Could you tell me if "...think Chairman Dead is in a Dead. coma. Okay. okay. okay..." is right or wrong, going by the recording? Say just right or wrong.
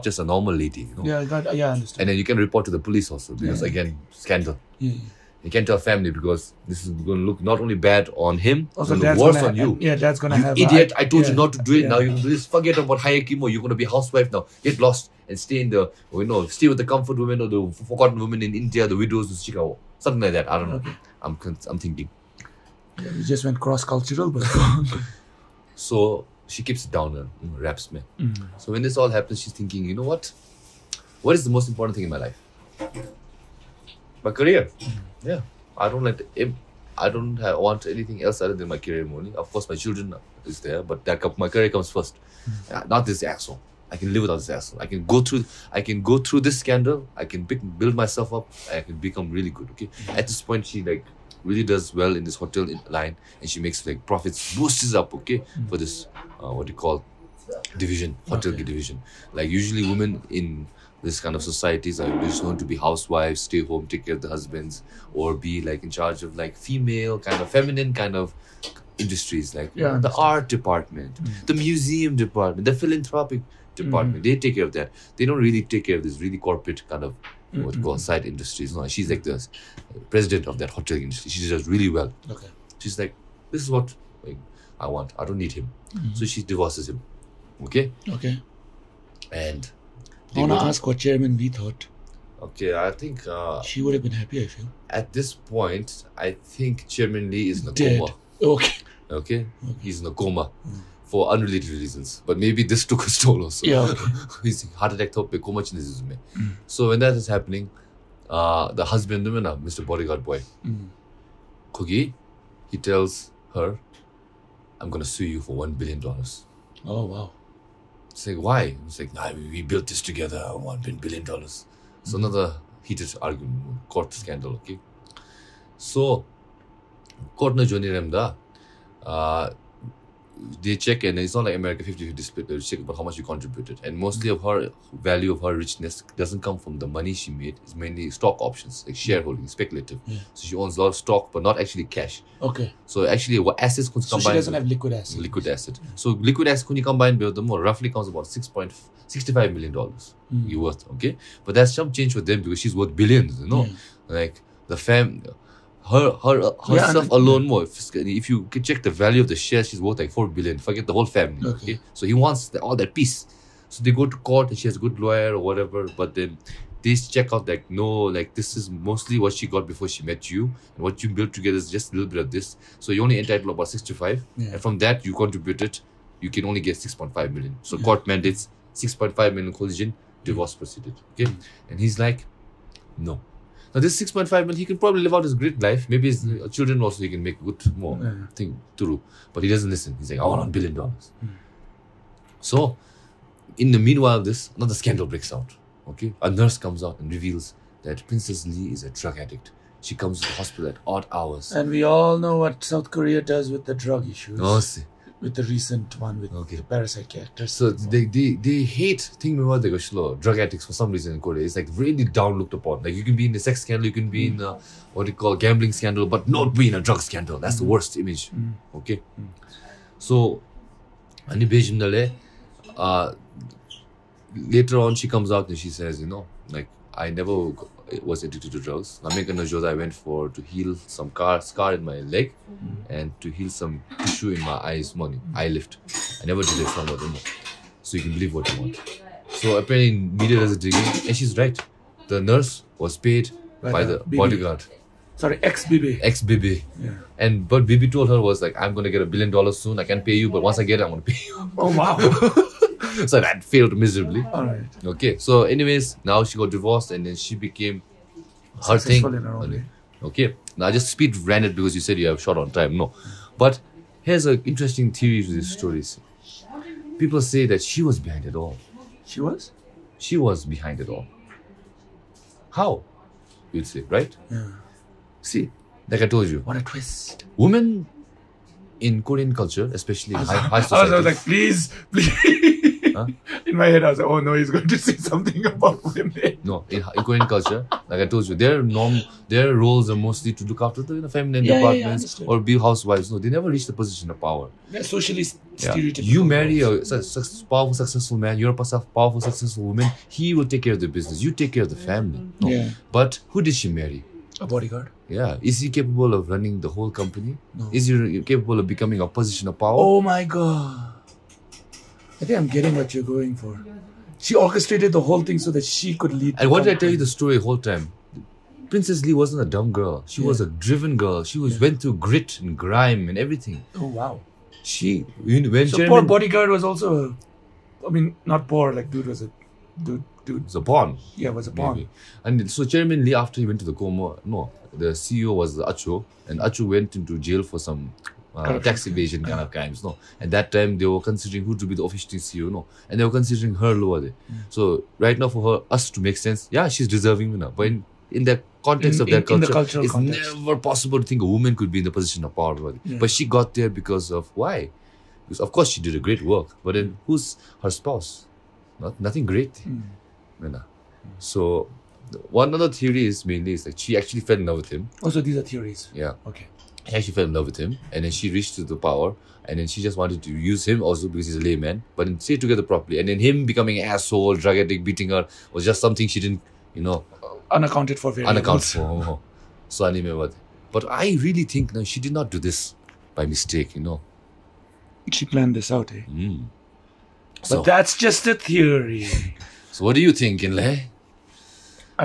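wrong.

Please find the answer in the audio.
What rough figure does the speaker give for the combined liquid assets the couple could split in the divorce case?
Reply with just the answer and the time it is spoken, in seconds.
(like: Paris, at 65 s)
6.65 million dollars, at 148 s.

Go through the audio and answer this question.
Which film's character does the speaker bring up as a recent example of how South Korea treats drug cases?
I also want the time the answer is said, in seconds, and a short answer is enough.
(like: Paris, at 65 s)
Parasite, at 206 s.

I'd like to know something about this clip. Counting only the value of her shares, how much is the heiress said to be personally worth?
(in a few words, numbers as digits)
4 billion.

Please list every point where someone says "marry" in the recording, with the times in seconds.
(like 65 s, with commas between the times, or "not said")
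296 s, 303 s.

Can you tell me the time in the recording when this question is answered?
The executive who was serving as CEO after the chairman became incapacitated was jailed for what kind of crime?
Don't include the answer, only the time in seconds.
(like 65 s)
338 s.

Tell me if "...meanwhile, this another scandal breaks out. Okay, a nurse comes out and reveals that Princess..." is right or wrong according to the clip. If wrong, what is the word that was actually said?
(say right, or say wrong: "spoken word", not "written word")
right.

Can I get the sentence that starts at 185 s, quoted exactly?
Maybe his children also he can make good more yeah.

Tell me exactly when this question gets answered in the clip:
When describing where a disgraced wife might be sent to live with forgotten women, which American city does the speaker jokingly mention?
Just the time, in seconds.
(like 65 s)
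19 s.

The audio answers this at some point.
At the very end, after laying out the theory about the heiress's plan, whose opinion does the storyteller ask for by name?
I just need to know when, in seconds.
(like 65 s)
390 s.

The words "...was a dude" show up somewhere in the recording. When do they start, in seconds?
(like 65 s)
329 s.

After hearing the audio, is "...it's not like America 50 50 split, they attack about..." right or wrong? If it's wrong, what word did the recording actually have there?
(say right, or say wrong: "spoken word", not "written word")
wrong: "check", not "attack".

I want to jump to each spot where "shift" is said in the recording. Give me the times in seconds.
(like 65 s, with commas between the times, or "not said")
not said.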